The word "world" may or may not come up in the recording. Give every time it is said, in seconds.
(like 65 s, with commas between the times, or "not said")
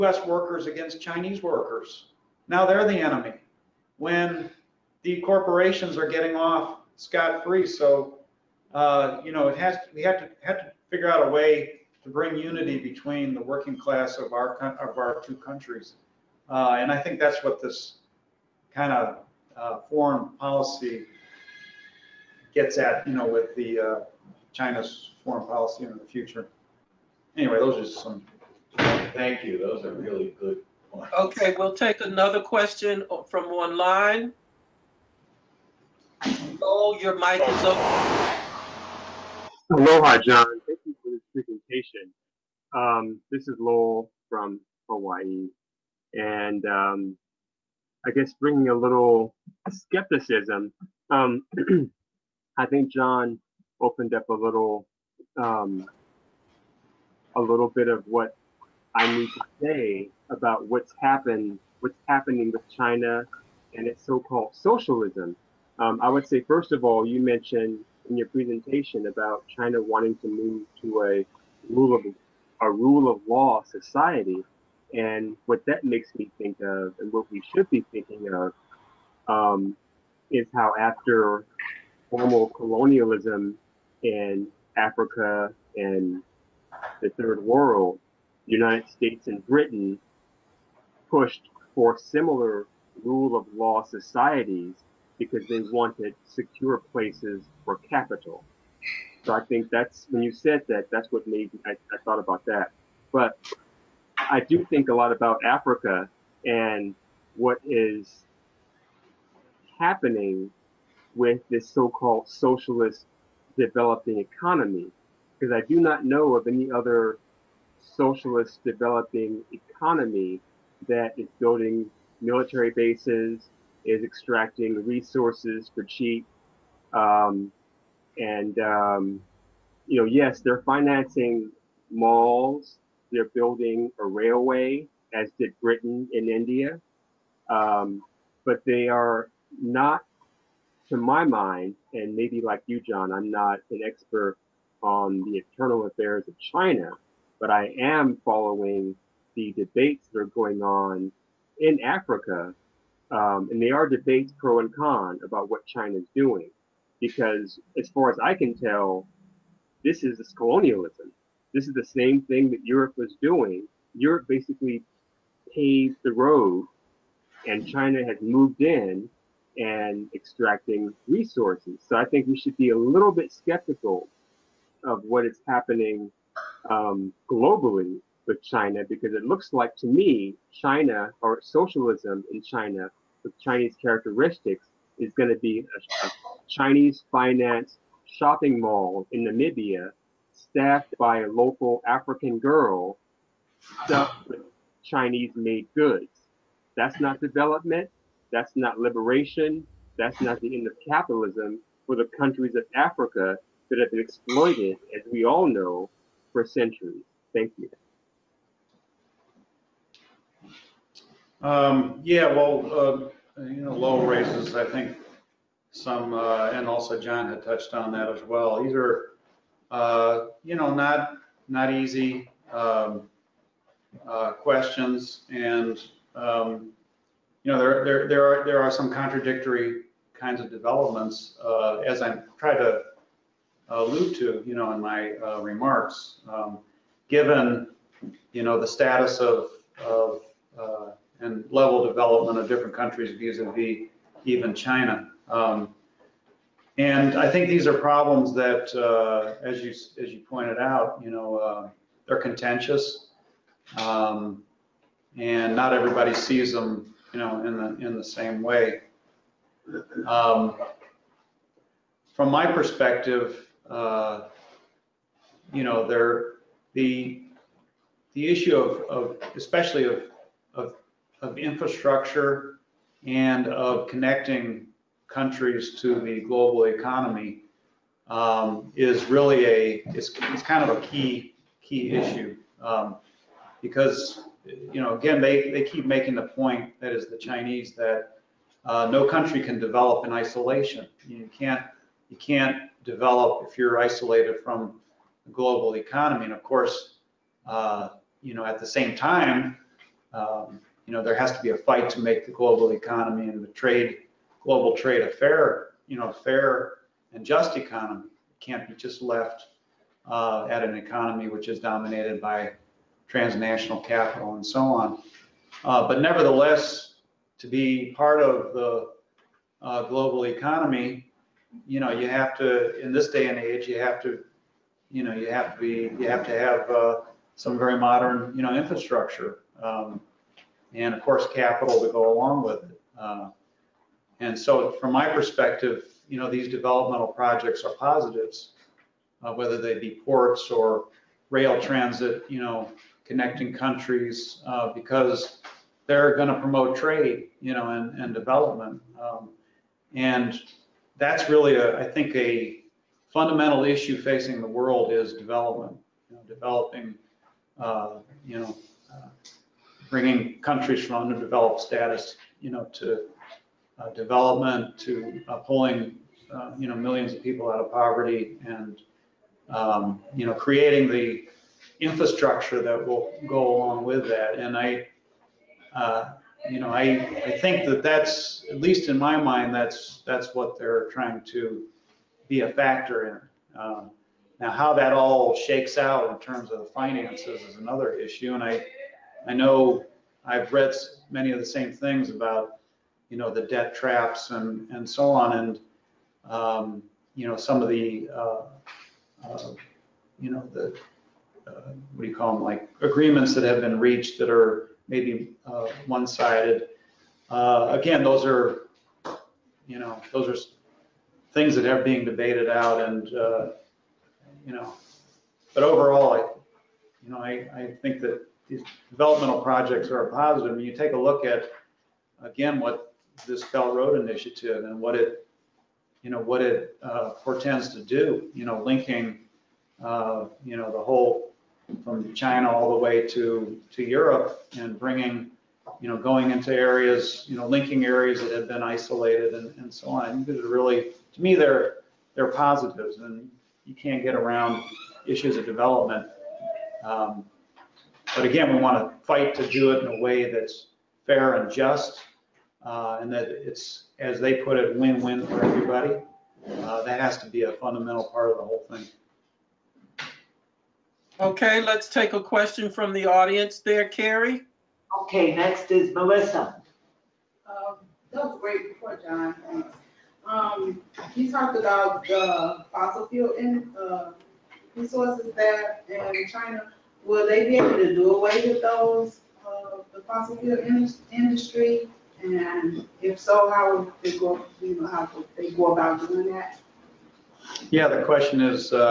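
87 s, 354 s.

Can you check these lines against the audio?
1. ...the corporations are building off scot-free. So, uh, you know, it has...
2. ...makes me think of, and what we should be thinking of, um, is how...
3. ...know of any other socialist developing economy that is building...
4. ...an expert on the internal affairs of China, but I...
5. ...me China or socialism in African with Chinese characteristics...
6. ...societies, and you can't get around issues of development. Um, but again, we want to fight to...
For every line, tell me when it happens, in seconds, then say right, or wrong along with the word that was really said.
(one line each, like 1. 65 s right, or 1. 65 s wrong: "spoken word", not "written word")
1. 5 s wrong: "getting", not "building"
2. 75 s right
3. 116 s right
4. 143 s right
5. 179 s wrong: "China", not "African"
6. 442 s wrong: "positives", not "societies".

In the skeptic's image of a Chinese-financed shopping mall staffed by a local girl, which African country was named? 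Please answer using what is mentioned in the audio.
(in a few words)
Namibia.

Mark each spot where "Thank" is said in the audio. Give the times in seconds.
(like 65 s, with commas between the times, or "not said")
29 s, 40 s, 207 s, 469 s.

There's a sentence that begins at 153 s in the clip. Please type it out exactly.
Um, and they are debates pro and con about what China is doing.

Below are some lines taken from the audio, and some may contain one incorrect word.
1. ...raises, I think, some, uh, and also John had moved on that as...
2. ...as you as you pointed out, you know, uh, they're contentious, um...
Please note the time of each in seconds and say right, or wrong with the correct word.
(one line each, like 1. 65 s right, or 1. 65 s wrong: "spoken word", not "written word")
1. 214 s wrong: "touched", not "moved"
2. 249 s right.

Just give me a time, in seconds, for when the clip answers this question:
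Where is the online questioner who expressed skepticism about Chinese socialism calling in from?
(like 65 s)
44 s.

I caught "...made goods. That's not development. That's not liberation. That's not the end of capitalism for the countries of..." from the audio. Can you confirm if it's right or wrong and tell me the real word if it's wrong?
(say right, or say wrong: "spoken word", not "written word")
right.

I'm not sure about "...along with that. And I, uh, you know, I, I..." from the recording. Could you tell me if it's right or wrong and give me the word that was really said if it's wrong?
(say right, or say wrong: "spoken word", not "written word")
right.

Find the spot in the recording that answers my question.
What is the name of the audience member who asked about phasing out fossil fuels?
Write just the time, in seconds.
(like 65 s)
465 s.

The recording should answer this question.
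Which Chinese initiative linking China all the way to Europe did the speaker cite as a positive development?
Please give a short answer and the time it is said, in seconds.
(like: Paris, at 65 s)
Belt Road initiative, at 423 s.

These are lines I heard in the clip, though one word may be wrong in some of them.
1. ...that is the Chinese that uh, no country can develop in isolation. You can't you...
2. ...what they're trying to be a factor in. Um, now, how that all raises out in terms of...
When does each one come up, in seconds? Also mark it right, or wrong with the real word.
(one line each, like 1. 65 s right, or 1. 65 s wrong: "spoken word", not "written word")
1. 286 s right
2. 380 s wrong: "shakes", not "raises".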